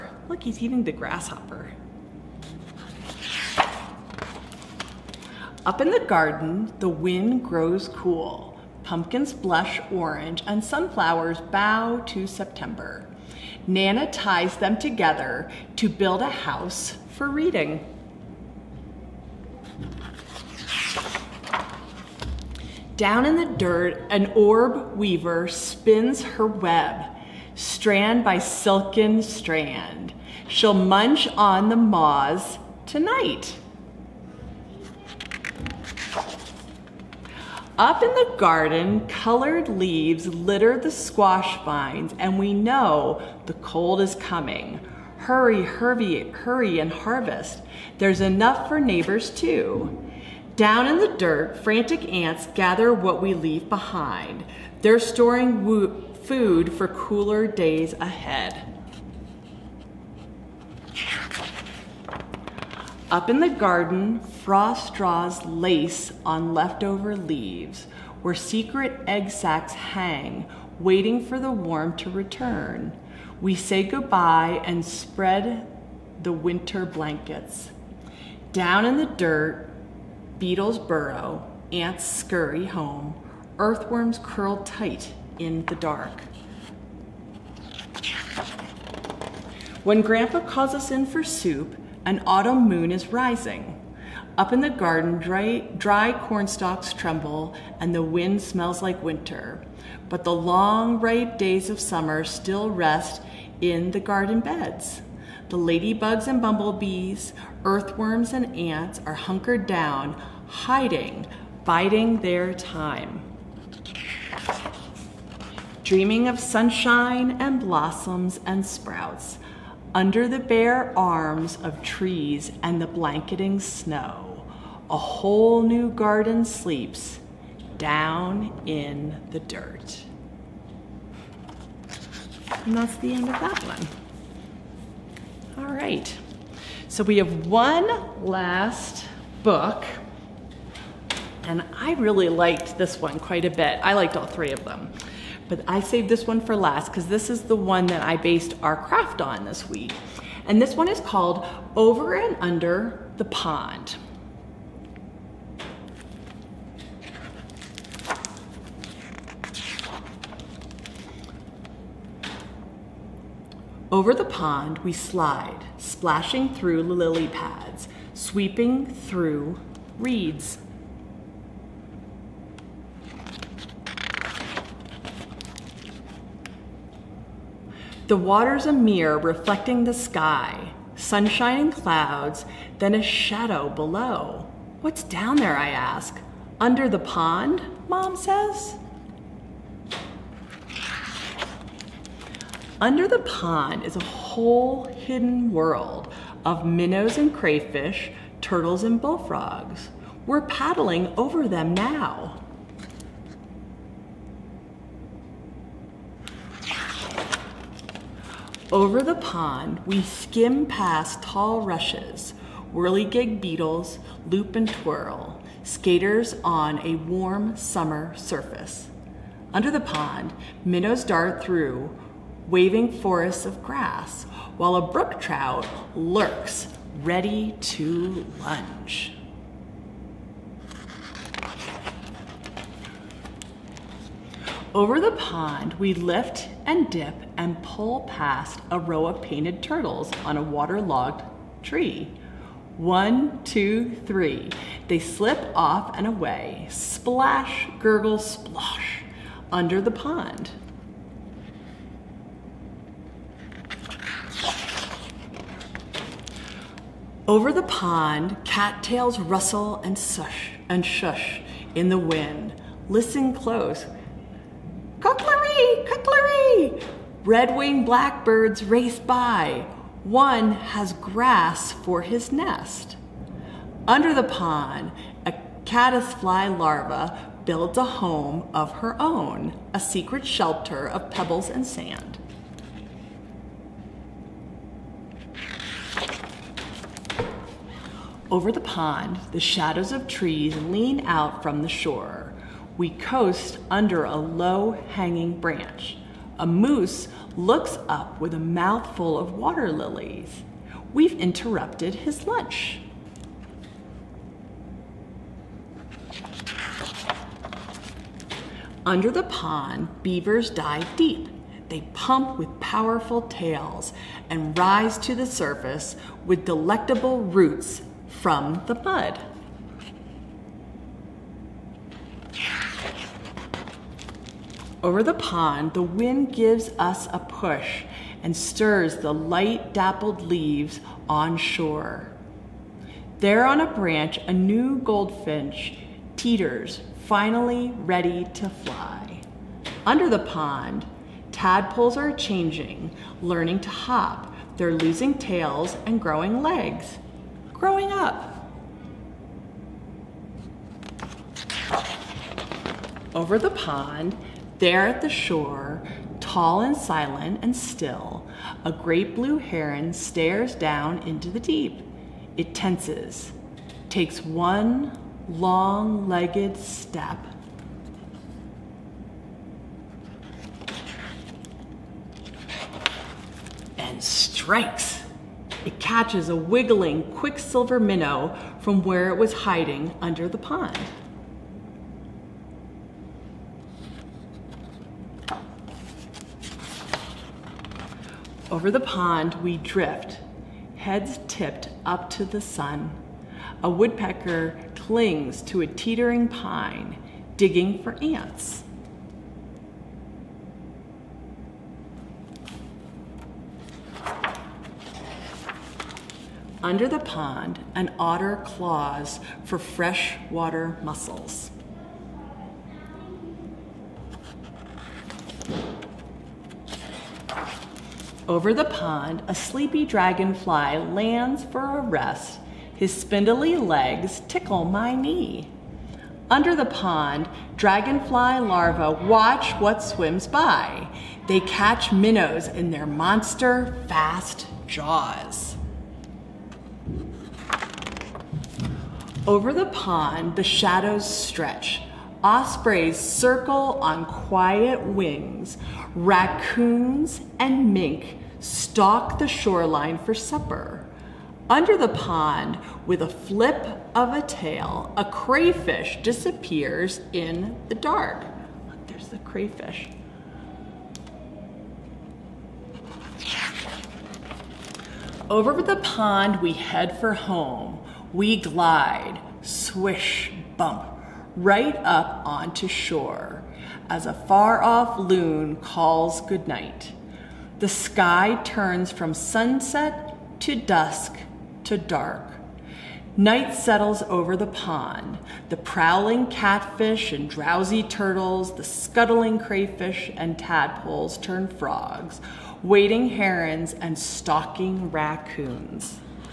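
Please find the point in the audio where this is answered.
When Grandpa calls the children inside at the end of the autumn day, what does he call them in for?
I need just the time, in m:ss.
1:31.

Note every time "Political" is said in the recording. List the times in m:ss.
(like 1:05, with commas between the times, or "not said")
not said.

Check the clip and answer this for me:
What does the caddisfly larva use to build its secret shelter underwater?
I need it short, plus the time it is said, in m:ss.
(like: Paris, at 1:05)
Pebbles and sand, at 4:41.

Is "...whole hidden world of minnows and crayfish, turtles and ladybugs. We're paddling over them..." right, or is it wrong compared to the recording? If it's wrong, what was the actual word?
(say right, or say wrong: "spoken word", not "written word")
wrong: "bullfrogs", not "ladybugs".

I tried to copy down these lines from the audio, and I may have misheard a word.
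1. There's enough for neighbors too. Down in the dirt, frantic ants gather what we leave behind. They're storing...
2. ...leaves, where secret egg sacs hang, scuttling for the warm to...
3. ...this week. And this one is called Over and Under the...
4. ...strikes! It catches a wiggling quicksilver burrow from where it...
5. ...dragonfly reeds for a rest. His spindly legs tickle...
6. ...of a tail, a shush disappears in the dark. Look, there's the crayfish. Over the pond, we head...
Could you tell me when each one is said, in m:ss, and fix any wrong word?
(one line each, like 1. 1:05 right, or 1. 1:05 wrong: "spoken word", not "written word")
1. 0:47 right
2. 1:07 wrong: "waiting", not "scuttling"
3. 2:29 right
4. 6:14 wrong: "minnow", not "burrow"
5. 6:59 wrong: "lands", not "reeds"
6. 7:33 wrong: "crayfish", not "shush".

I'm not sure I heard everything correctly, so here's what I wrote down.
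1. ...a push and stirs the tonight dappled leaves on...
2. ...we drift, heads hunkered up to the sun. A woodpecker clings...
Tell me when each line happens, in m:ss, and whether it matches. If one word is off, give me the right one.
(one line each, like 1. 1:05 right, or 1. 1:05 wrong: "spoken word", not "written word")
1. 5:27 wrong: "light", not "tonight"
2. 6:29 wrong: "tipped", not "hunkered".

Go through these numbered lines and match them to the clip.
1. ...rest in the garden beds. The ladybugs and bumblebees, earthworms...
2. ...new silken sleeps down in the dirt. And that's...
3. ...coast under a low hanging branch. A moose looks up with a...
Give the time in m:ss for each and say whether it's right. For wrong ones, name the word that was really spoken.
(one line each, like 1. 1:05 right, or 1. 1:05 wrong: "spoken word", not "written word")
1. 1:42 right
2. 2:05 wrong: "garden", not "silken"
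3. 4:52 right.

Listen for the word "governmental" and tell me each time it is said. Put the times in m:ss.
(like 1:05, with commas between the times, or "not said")
not said.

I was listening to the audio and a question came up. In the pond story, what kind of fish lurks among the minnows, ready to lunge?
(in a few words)
Brook trout.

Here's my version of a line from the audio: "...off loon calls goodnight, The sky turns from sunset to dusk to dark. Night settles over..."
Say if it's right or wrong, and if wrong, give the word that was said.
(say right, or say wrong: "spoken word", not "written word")
right.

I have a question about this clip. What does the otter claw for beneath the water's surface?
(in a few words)
Freshwater mussels.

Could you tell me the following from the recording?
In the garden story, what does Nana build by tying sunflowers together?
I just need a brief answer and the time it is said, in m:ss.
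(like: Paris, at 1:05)
A house for reading, at 0:16.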